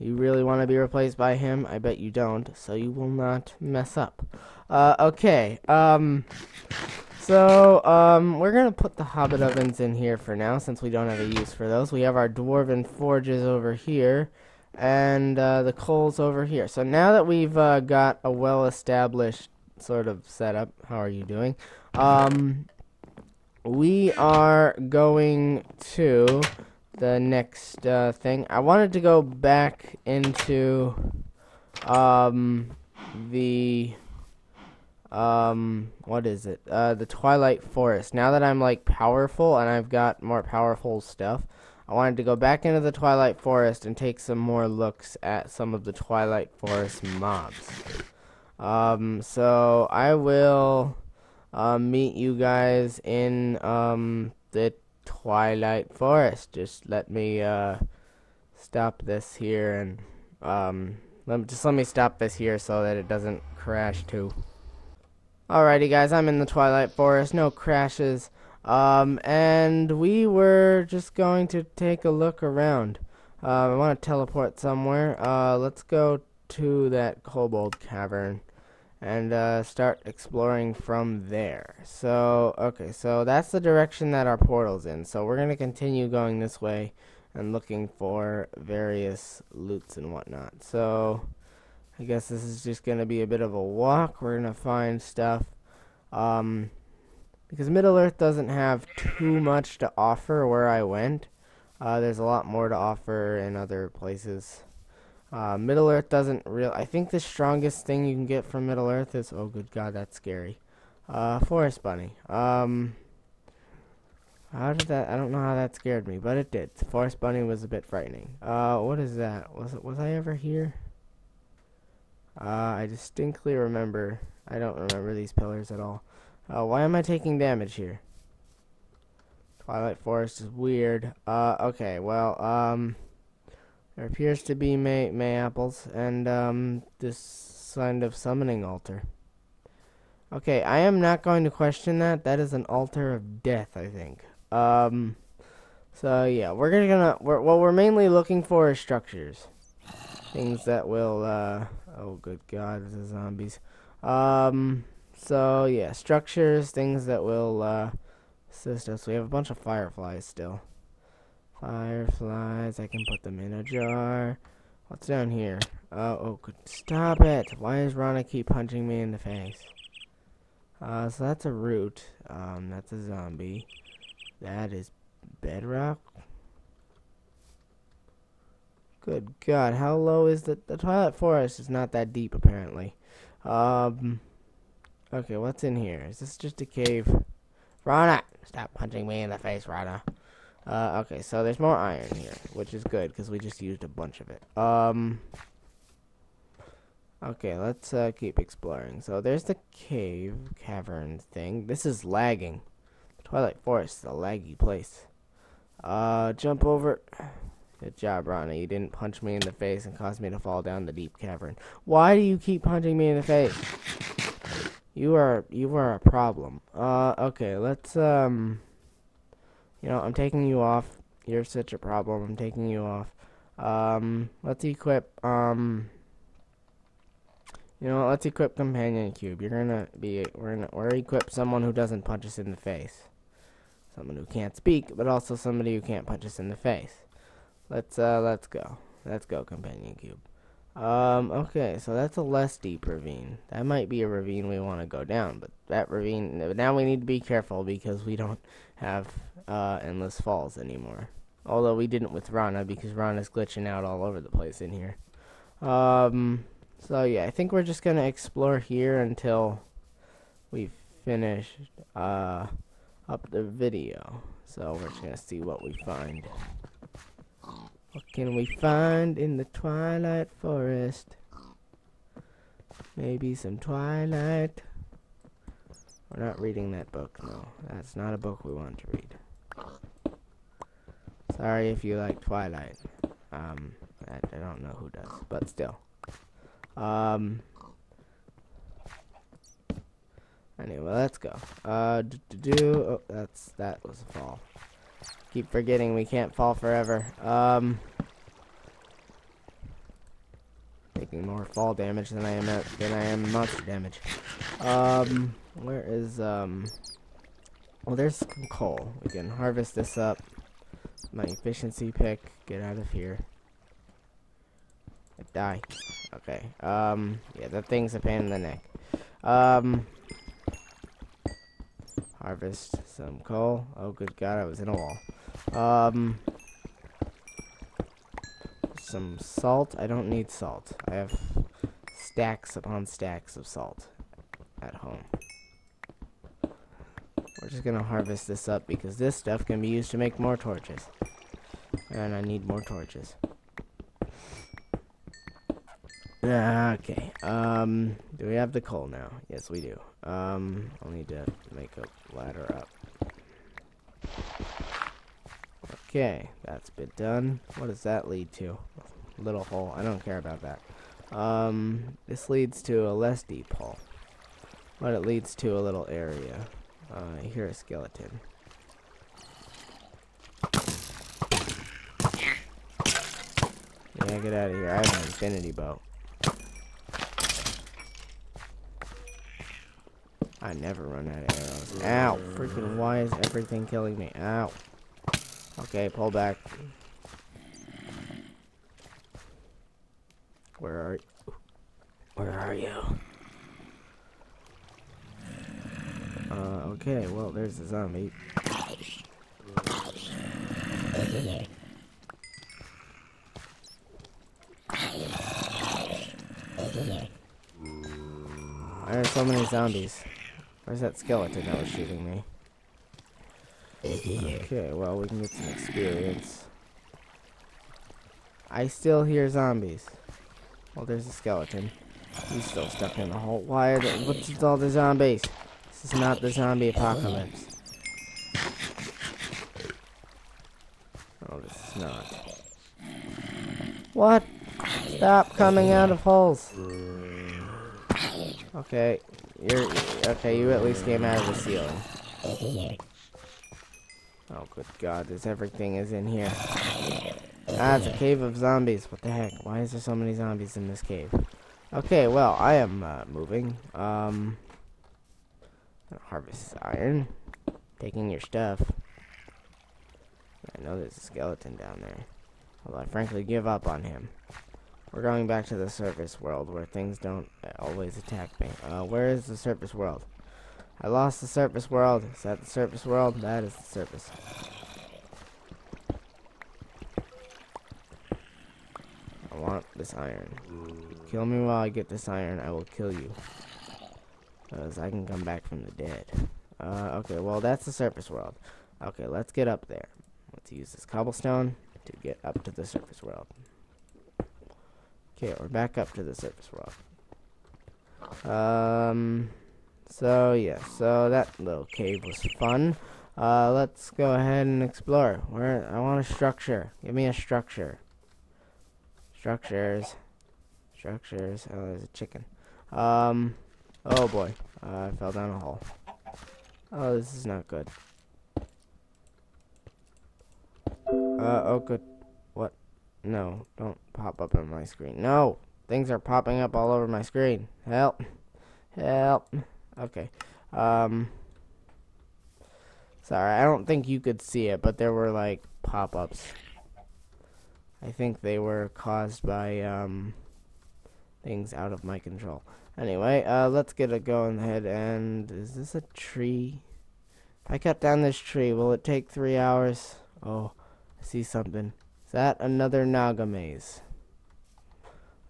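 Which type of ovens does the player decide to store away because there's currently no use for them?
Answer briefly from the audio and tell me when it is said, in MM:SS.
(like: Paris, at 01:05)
hobbit ovens, at 00:09.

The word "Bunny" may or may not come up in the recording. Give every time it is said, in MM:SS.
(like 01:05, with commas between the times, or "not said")
01:51, 01:57.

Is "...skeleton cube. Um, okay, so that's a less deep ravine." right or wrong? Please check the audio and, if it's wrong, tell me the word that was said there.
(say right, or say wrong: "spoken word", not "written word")
wrong: "companion", not "skeleton".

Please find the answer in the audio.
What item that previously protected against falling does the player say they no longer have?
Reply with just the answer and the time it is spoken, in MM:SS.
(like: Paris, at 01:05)
Endless Falls, at 04:09.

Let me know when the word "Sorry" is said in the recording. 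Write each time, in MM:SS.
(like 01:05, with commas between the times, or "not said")
04:41, 08:53.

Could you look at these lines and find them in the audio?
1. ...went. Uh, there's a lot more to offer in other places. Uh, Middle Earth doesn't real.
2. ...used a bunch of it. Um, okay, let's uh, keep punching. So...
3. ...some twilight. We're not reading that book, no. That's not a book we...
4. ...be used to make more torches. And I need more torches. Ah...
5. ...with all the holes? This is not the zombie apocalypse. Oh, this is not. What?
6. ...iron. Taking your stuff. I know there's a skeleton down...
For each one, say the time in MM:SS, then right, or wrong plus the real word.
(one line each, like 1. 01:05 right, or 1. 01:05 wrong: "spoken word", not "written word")
1. 01:40 right
2. 03:13 wrong: "exploring", not "punching"
3. 04:33 right
4. 05:39 right
5. 07:04 wrong: "zombies", not "holes"
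6. 07:36 right.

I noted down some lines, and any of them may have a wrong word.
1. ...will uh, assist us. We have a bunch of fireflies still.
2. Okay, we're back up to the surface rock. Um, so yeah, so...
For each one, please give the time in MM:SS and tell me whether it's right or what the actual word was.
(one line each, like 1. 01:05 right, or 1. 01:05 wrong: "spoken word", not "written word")
1. 02:37 right
2. 08:15 right.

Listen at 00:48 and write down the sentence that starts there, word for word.
Um, so I will uh, meet you guys in um, the Twilight Forest.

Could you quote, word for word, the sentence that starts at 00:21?
Um, we are going to the next uh, thing.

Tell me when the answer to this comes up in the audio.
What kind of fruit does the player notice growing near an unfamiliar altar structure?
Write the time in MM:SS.
02:15.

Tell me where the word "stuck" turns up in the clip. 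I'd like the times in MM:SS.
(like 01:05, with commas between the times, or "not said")
07:02.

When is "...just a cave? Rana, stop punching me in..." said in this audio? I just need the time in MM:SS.
03:06.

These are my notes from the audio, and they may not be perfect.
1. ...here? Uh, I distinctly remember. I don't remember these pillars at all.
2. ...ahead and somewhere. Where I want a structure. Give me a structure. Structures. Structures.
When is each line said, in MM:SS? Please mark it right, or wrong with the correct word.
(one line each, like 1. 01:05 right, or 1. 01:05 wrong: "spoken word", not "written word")
1. 02:00 right
2. 08:24 wrong: "explore", not "somewhere".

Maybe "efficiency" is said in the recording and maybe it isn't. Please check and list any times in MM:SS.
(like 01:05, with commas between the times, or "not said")
05:11.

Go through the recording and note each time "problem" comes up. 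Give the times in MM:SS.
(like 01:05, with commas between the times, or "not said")
03:35, 03:41.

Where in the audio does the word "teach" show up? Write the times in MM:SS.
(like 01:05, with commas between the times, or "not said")
not said.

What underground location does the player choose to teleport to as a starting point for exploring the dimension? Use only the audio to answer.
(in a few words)
kobold cavern.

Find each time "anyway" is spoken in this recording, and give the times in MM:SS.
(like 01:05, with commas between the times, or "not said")
04:50, 09:02.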